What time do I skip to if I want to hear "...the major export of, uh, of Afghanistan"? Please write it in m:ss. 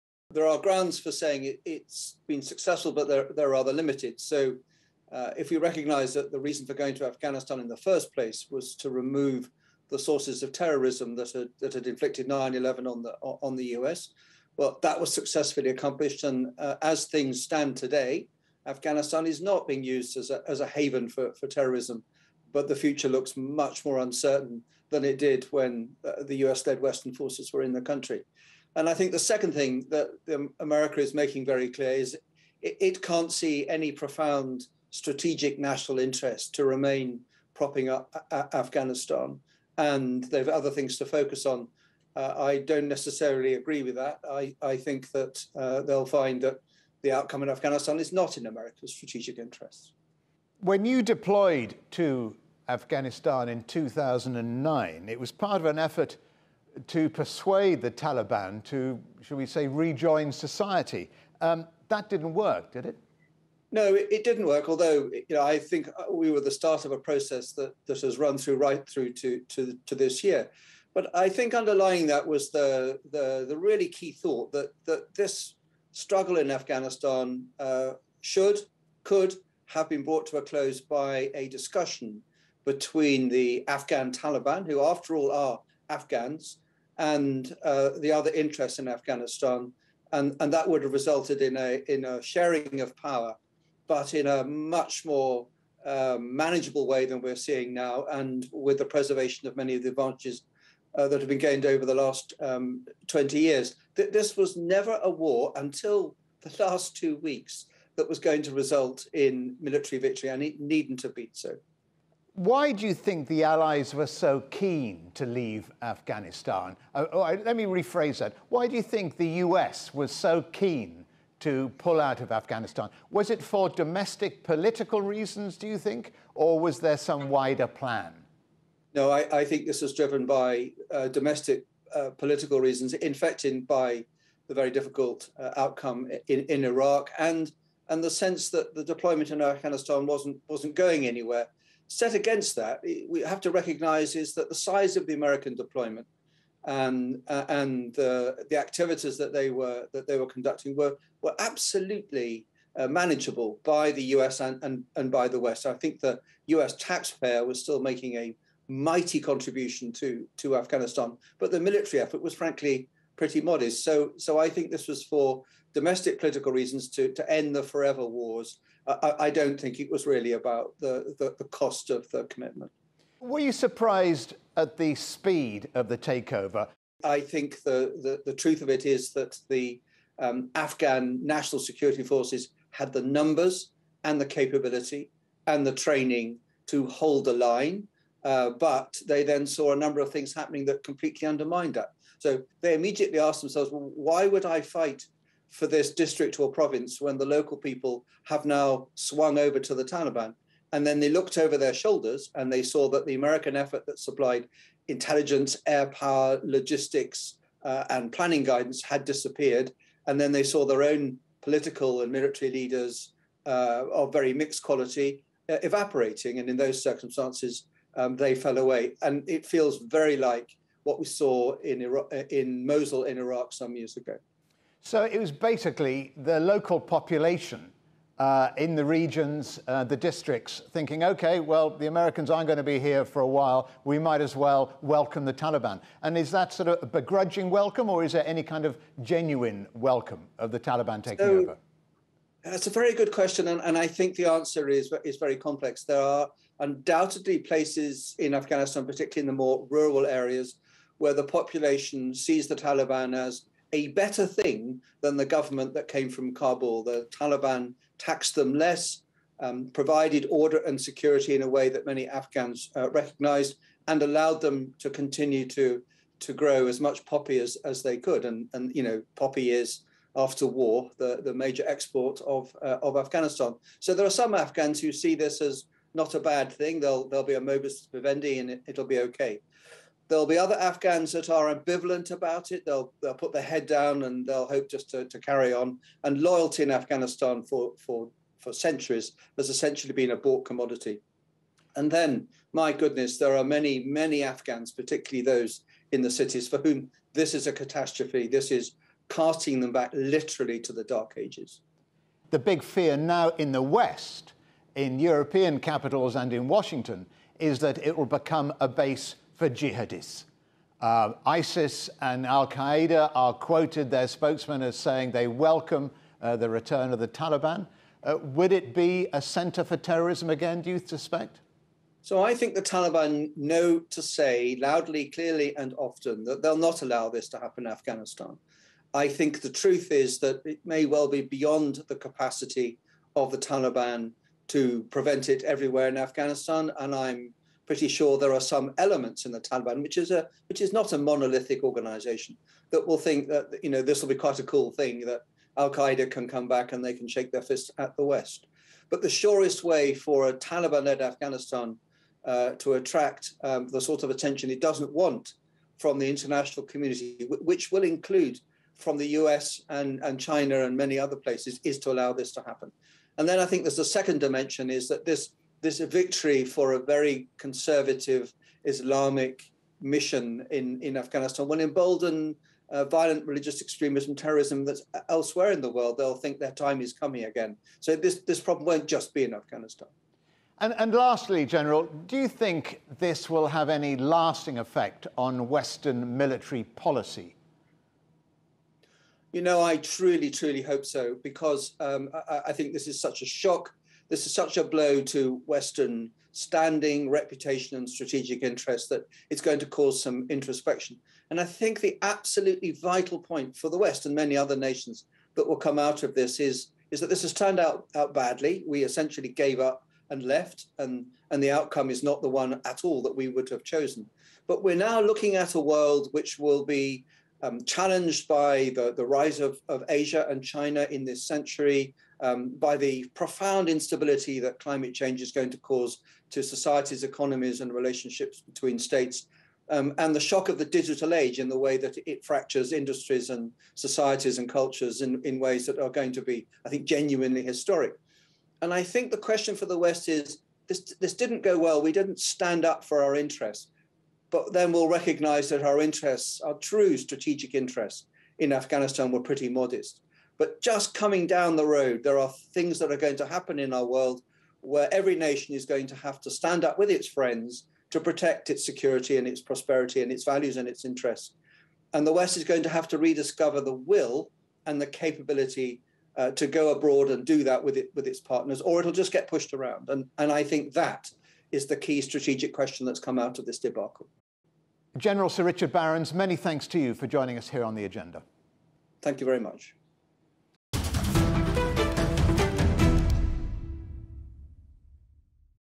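4:31.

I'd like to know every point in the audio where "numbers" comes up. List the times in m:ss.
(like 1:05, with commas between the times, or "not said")
3:03, 3:09.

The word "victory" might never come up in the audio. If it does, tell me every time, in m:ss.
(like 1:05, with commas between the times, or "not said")
1:49, 6:05.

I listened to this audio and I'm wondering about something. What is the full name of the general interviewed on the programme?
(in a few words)
Sir Richard Barrons.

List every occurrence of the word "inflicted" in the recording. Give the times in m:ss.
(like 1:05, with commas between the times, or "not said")
0:11.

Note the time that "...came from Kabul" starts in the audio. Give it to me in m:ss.
4:15.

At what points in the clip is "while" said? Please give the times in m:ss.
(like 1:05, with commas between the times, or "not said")
3:53.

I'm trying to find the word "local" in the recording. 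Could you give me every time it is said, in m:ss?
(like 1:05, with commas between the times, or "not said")
3:17, 3:46.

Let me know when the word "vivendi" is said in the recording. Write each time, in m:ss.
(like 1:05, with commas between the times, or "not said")
4:37.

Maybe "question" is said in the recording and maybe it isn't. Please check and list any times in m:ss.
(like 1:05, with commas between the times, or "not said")
4:03, 7:19, 7:52.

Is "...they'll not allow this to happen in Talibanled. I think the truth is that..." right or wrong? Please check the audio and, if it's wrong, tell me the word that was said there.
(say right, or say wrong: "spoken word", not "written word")
wrong: "Afghanistan", not "Talibanled".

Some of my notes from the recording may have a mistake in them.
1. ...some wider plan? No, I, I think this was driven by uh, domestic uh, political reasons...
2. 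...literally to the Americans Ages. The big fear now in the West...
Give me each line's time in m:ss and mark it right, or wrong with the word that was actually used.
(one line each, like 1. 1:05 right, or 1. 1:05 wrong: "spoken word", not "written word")
1. 2:06 right
2. 4:59 wrong: "Dark", not "Americans".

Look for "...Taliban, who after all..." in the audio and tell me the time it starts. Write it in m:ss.
1:24.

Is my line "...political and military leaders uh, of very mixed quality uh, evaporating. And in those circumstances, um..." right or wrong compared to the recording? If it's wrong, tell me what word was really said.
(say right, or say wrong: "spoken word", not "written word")
right.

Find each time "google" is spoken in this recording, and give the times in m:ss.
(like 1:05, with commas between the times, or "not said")
not said.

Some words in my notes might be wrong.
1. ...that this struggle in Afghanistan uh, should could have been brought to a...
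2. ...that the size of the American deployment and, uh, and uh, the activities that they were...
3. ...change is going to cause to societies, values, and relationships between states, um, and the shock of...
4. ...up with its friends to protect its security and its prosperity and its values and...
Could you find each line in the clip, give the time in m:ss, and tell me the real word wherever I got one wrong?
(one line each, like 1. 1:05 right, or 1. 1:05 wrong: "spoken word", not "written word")
1. 1:14 right
2. 2:24 right
3. 7:04 wrong: "economies", not "values"
4. 7:36 right.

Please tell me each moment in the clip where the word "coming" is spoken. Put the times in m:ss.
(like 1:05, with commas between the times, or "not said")
6:16, 7:30.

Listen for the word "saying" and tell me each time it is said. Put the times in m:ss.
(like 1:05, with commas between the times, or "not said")
0:01, 5:14.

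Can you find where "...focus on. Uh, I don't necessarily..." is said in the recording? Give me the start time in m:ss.
0:41.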